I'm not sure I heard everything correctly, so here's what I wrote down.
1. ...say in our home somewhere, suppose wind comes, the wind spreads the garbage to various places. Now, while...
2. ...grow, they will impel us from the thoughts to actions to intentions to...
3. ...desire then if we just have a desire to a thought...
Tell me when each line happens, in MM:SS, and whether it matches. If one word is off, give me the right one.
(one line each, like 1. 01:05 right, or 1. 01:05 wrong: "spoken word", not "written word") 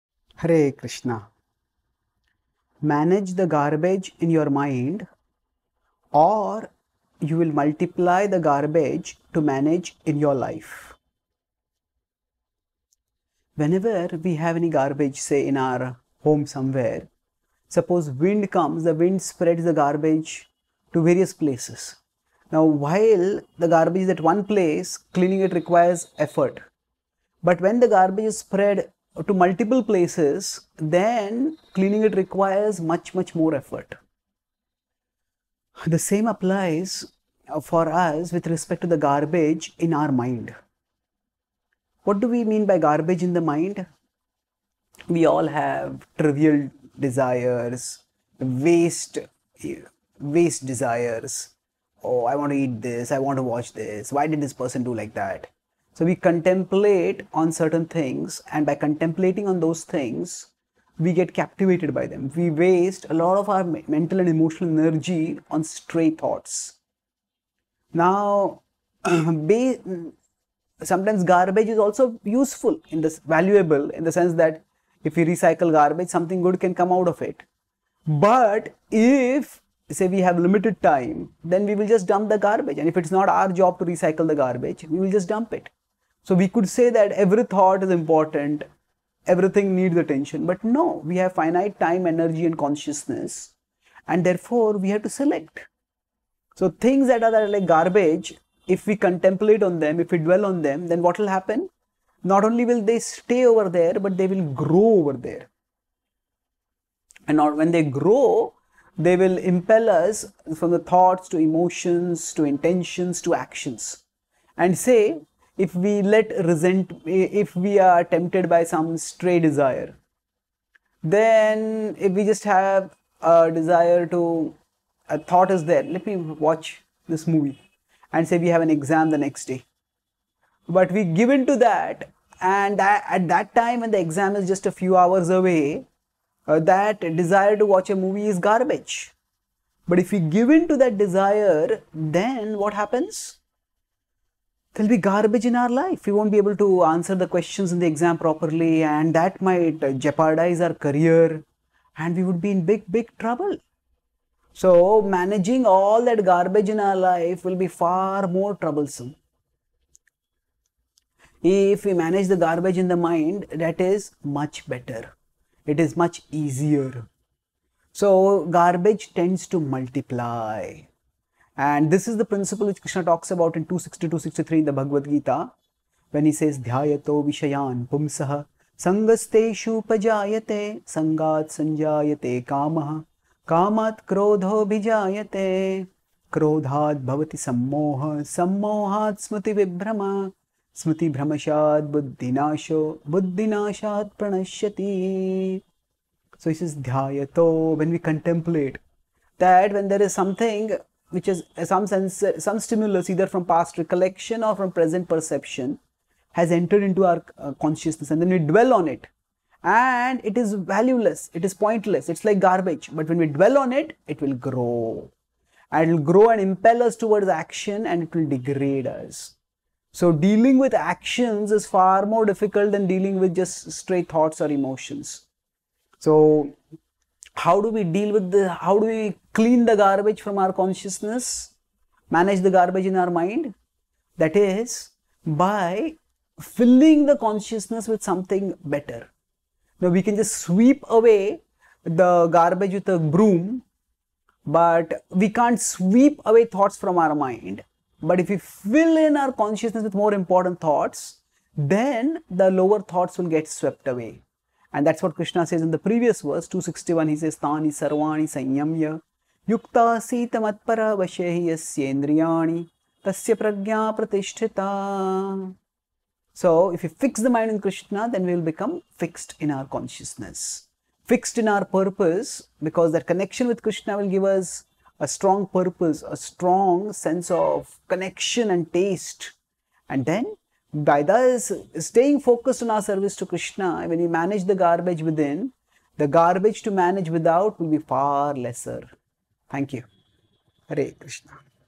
1. 00:15 right
2. 01:47 wrong: "emotions", not "actions"
3. 01:59 right.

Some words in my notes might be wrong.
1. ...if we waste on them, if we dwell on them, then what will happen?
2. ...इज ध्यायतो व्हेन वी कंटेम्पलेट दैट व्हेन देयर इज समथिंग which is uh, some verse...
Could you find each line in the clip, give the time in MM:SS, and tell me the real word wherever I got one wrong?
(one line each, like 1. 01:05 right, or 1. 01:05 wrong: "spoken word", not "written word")
1. 01:38 wrong: "contemplate", not "waste"
2. 03:16 wrong: "sense", not "verse".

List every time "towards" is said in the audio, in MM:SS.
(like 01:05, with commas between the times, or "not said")
03:36.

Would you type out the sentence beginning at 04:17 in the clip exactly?
He says, Tani sarvani sanyamya yukta matpara vashehi yasyendriyani tasya pragya pratishtita.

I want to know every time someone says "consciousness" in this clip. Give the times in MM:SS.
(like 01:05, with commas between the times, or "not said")
01:32, 03:27, 03:50, 03:57, 04:09, 04:29.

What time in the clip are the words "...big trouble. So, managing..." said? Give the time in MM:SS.
02:32.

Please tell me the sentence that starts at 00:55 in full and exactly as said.
So we contemplate on certain things, and by contemplating on those things, we get captivated by them.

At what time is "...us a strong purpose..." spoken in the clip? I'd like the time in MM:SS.
04:34.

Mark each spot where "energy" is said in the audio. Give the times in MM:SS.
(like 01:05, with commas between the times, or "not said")
01:04, 01:32.